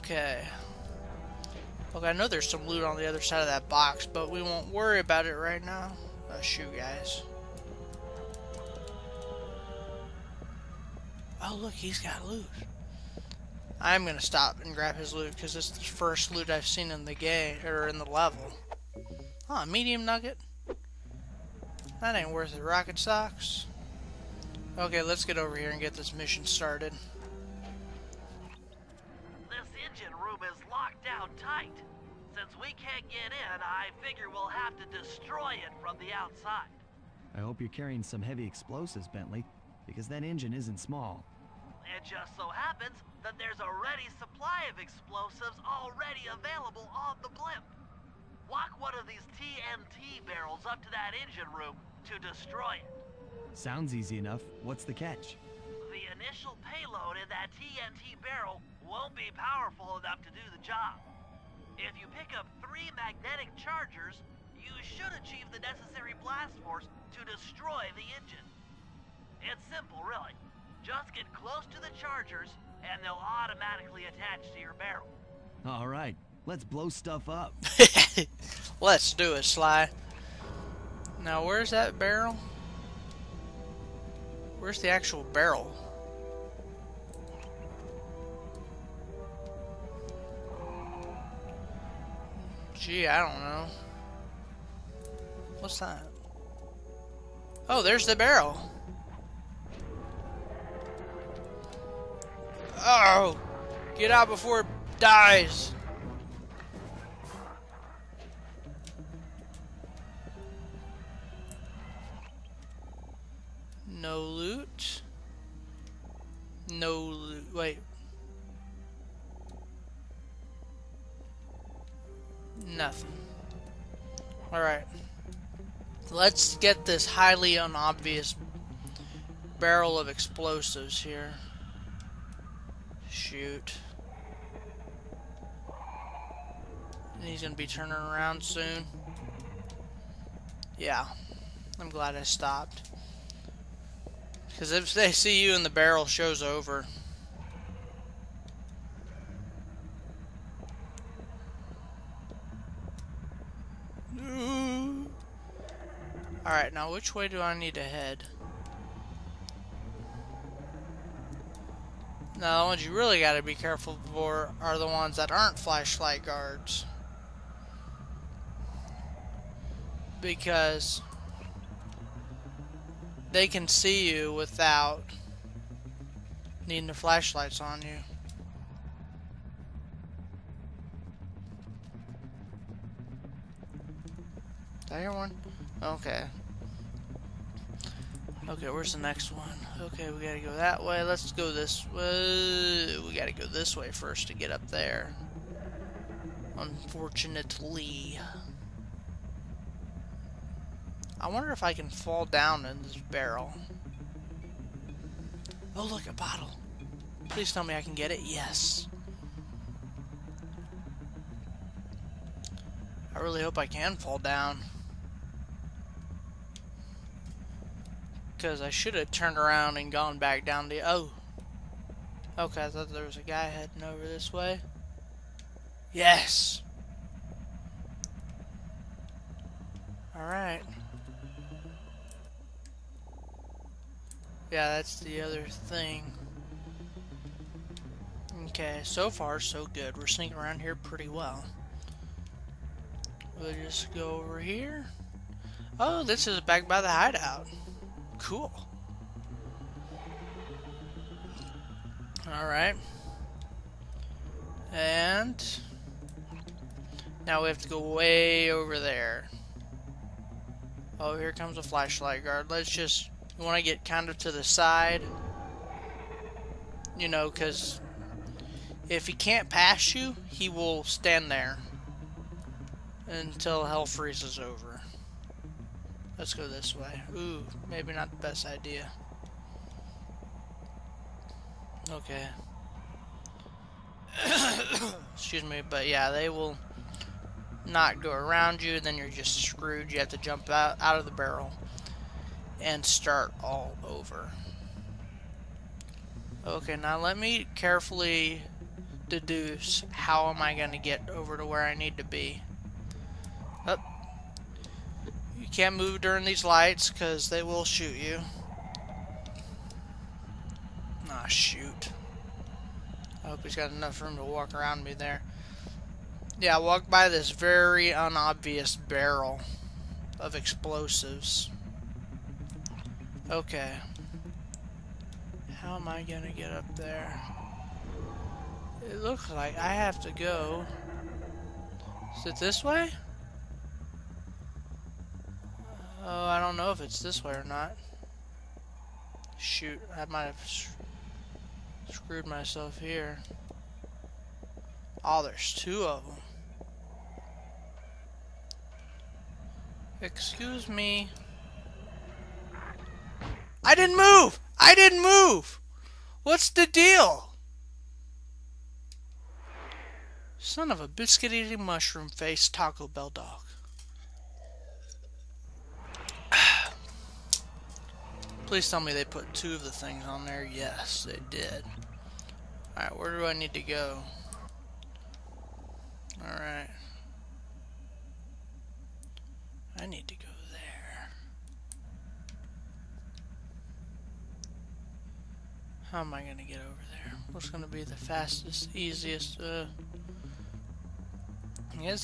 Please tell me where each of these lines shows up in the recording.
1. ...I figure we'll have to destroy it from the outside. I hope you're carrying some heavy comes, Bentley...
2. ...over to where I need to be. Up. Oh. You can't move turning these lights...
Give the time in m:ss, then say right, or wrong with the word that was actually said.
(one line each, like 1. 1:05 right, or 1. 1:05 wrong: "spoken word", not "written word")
1. 0:33 wrong: "explosives", not "comes"
2. 5:01 wrong: "during", not "turning".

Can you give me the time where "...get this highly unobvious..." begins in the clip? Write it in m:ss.
2:06.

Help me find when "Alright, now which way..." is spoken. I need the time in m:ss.
2:36.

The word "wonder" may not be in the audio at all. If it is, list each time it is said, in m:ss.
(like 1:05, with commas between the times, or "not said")
3:21.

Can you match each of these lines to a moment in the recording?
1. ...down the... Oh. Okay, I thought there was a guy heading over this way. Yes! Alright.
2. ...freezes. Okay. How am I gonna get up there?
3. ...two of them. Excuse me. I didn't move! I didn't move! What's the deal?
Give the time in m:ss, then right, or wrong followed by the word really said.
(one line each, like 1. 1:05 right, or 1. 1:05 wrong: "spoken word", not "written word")
1. 3:40 right
2. 5:20 wrong: "explosives", not "freezes"
3. 5:45 right.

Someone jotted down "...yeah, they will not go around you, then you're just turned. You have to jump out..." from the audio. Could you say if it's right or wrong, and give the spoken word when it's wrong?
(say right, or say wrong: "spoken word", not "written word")
wrong: "screwed", not "turned".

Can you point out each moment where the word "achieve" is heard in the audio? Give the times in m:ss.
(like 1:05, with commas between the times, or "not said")
1:05.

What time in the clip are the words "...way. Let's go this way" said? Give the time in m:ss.
3:10.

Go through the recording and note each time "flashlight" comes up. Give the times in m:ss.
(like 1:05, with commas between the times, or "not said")
2:45, 2:56, 4:21.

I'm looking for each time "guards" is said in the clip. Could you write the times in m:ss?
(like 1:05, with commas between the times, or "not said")
2:46, 4:22.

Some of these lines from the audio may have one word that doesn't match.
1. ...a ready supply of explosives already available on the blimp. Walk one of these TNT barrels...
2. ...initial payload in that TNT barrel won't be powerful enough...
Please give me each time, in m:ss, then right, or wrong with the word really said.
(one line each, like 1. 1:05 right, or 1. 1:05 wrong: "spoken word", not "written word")
1. 0:43 right
2. 0:56 right.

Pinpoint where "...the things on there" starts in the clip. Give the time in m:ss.
6:09.